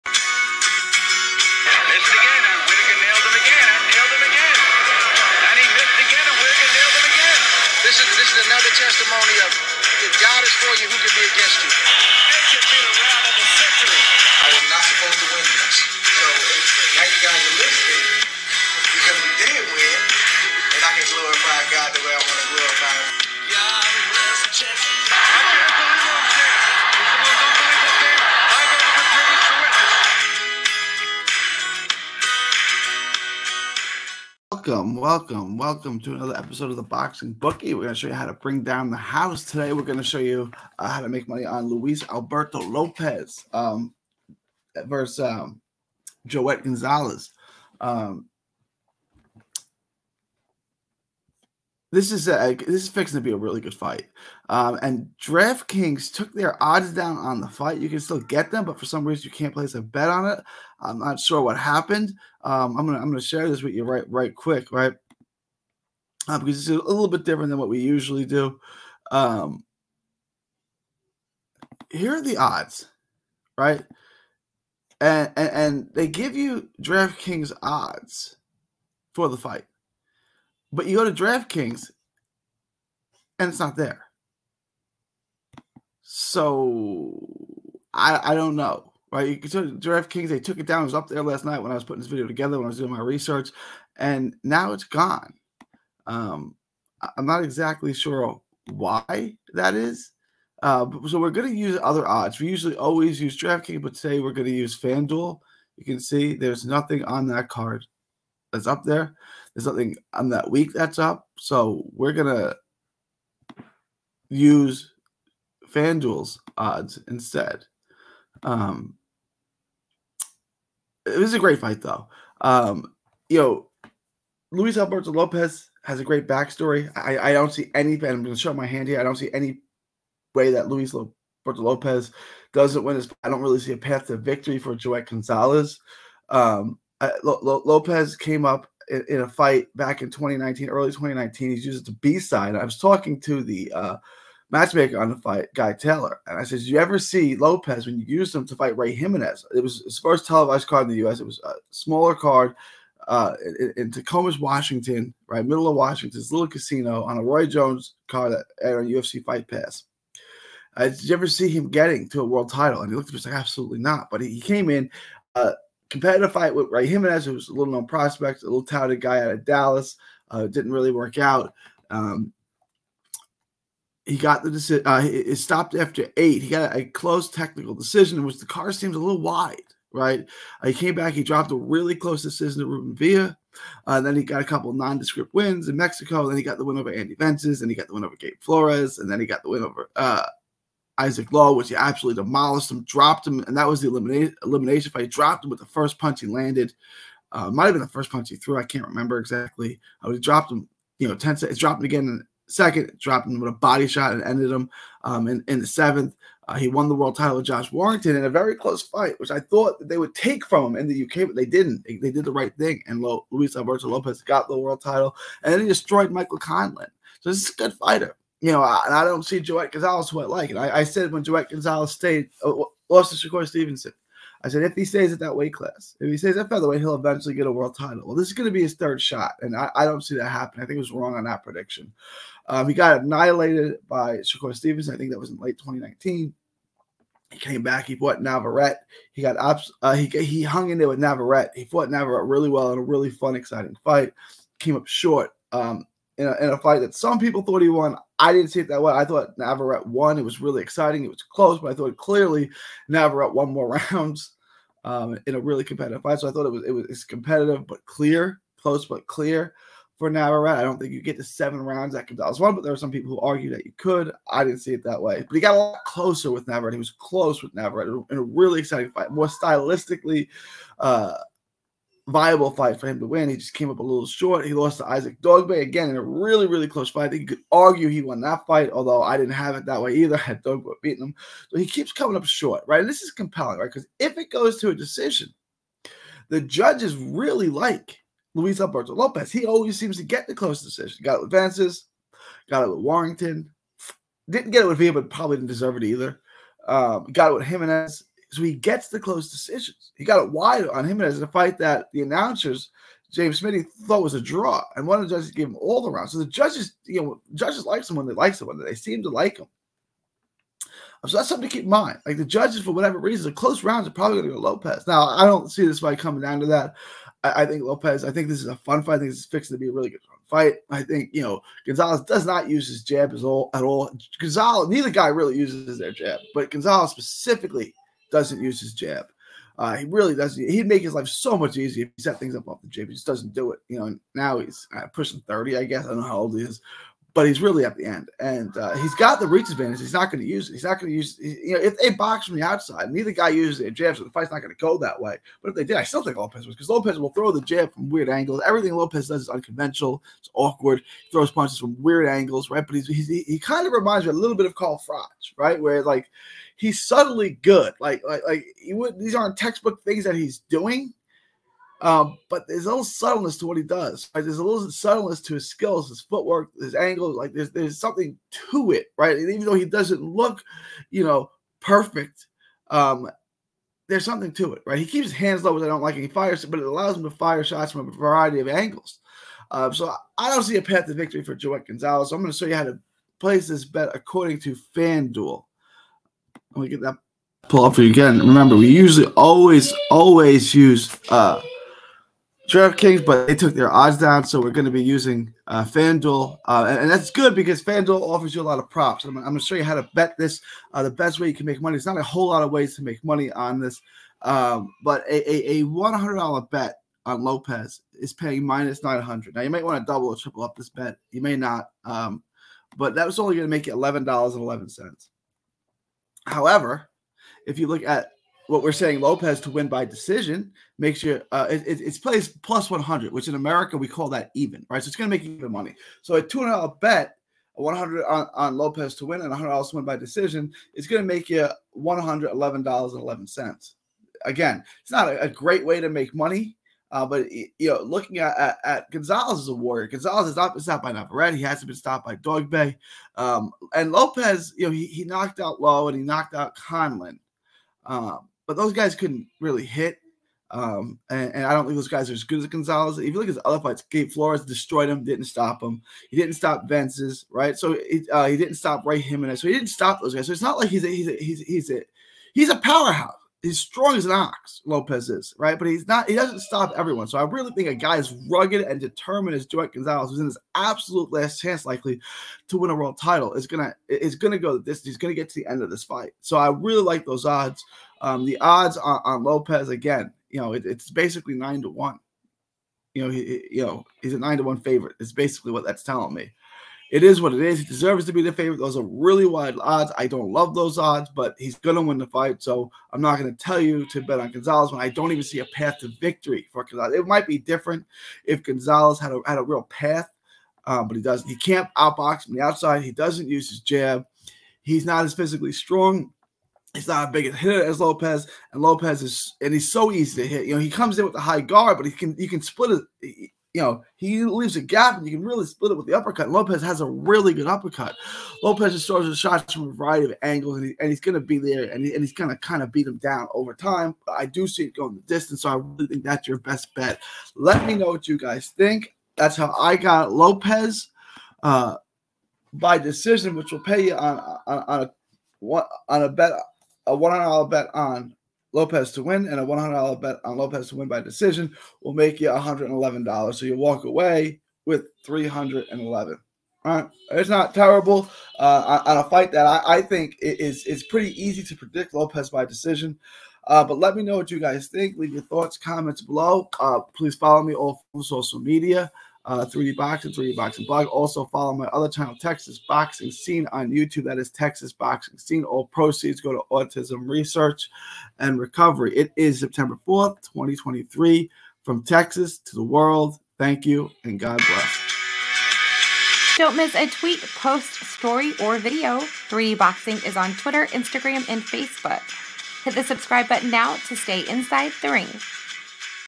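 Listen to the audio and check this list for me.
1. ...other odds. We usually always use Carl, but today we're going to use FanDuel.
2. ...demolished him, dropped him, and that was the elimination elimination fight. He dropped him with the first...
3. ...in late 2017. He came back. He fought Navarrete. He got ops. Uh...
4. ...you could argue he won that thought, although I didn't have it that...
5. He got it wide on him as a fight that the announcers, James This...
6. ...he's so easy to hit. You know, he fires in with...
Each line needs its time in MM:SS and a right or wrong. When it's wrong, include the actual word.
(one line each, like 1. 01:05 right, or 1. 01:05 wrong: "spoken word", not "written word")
1. 01:41 wrong: "DraftKings", not "Carl"
2. 03:12 right
3. 03:55 wrong: "2019", not "2017"
4. 04:37 wrong: "fight", not "thought"
5. 04:59 wrong: "Smitty", not "This"
6. 08:29 wrong: "comes", not "fires".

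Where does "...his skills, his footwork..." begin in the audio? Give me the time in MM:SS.
06:05.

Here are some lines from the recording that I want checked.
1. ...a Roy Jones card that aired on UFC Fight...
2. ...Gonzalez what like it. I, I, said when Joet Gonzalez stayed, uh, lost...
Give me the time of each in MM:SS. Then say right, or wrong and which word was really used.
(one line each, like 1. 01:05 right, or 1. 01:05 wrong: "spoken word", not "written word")
1. 02:37 right
2. 03:39 right.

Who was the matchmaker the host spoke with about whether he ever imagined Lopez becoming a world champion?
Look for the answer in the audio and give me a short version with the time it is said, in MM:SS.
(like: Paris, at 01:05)
Guy Taylor, at 02:25.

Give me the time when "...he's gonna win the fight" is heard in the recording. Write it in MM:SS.
08:11.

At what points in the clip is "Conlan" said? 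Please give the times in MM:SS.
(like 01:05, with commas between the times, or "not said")
03:36, 07:26.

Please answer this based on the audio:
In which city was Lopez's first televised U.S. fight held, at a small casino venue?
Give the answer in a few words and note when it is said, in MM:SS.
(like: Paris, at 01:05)
Tacoma, at 02:33.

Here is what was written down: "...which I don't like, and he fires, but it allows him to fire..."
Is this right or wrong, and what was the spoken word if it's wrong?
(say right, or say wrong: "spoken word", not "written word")
right.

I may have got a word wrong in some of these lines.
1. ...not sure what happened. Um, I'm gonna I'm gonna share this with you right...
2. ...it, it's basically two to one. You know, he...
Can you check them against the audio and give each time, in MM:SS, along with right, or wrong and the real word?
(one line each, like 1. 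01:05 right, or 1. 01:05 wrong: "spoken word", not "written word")
1. 01:00 right
2. 08:00 wrong: "nine", not "two".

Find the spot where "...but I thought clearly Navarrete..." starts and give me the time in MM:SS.
04:11.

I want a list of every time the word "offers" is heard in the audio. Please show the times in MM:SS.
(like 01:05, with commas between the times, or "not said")
06:38.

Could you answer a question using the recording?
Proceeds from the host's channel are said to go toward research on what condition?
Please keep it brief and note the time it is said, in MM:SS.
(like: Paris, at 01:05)
Autism, at 09:26.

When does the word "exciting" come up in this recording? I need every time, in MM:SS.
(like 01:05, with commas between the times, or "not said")
04:03, 04:10, 04:28.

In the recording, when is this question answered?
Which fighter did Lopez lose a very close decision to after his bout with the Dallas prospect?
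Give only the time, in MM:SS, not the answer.
03:02.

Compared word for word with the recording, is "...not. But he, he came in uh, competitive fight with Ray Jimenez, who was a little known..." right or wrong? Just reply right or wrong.
right.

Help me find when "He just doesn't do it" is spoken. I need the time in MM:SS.
05:32.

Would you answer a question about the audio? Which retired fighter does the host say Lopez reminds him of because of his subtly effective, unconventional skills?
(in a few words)
Carl Froch.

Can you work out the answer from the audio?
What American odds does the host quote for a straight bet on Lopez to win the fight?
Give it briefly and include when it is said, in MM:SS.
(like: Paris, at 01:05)
-900, at 06:48.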